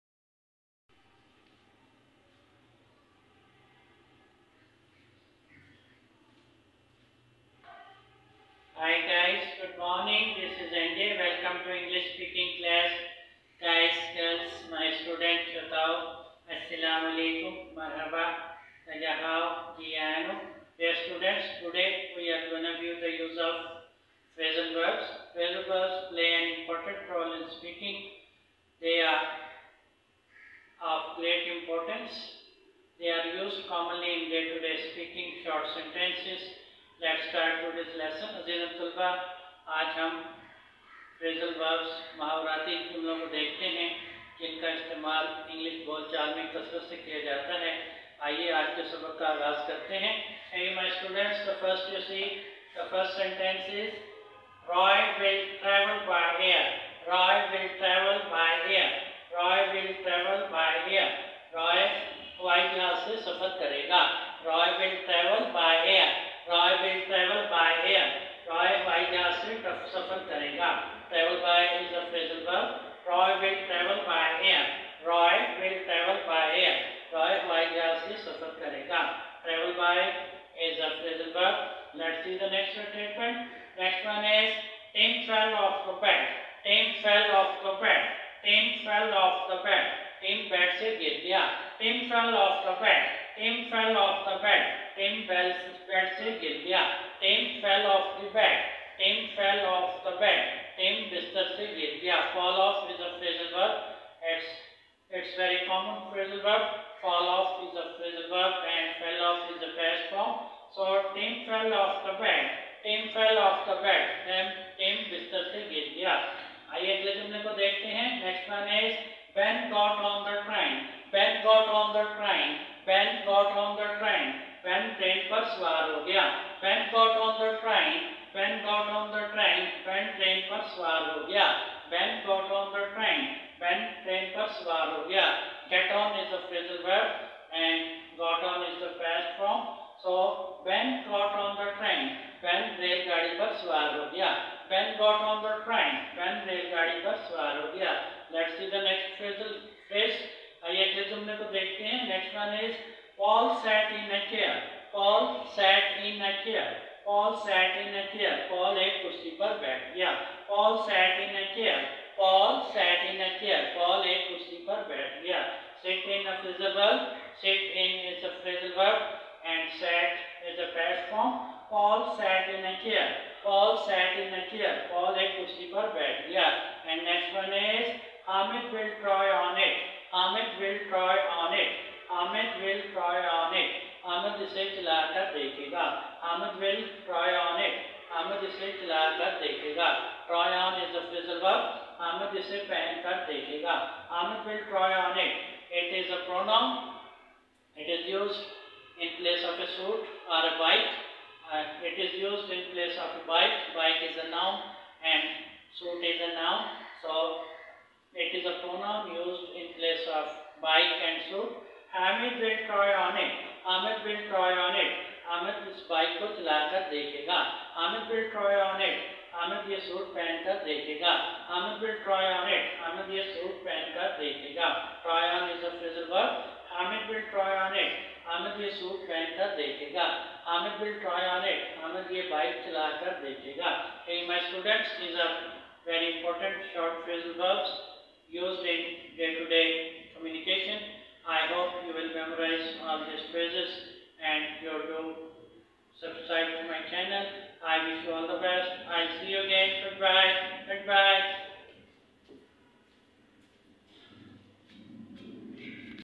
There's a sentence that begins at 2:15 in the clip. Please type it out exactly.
Yeah, get on is the phrasal verb and got on is the past form.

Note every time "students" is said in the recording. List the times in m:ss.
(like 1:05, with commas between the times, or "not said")
0:15, 0:21, 3:54.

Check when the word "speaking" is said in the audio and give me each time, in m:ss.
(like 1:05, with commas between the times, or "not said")
0:12, 0:27, 0:34.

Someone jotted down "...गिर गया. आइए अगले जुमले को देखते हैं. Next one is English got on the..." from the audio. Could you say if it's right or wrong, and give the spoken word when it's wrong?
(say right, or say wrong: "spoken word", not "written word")
wrong: "Ben", not "English".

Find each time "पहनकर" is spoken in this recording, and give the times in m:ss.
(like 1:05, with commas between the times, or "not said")
3:12, 3:49.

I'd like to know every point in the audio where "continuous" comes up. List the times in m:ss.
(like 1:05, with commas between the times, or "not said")
not said.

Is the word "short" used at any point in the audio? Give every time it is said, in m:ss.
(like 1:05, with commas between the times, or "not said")
0:35, 3:56.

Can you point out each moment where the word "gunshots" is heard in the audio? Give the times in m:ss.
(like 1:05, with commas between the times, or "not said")
not said.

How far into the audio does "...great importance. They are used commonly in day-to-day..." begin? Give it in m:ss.
0:31.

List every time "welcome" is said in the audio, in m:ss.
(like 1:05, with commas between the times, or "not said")
0:11.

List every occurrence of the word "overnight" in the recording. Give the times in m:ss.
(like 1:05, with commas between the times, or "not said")
not said.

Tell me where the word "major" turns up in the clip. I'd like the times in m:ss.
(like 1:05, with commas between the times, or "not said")
not said.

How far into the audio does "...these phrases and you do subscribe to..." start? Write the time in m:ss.
4:03.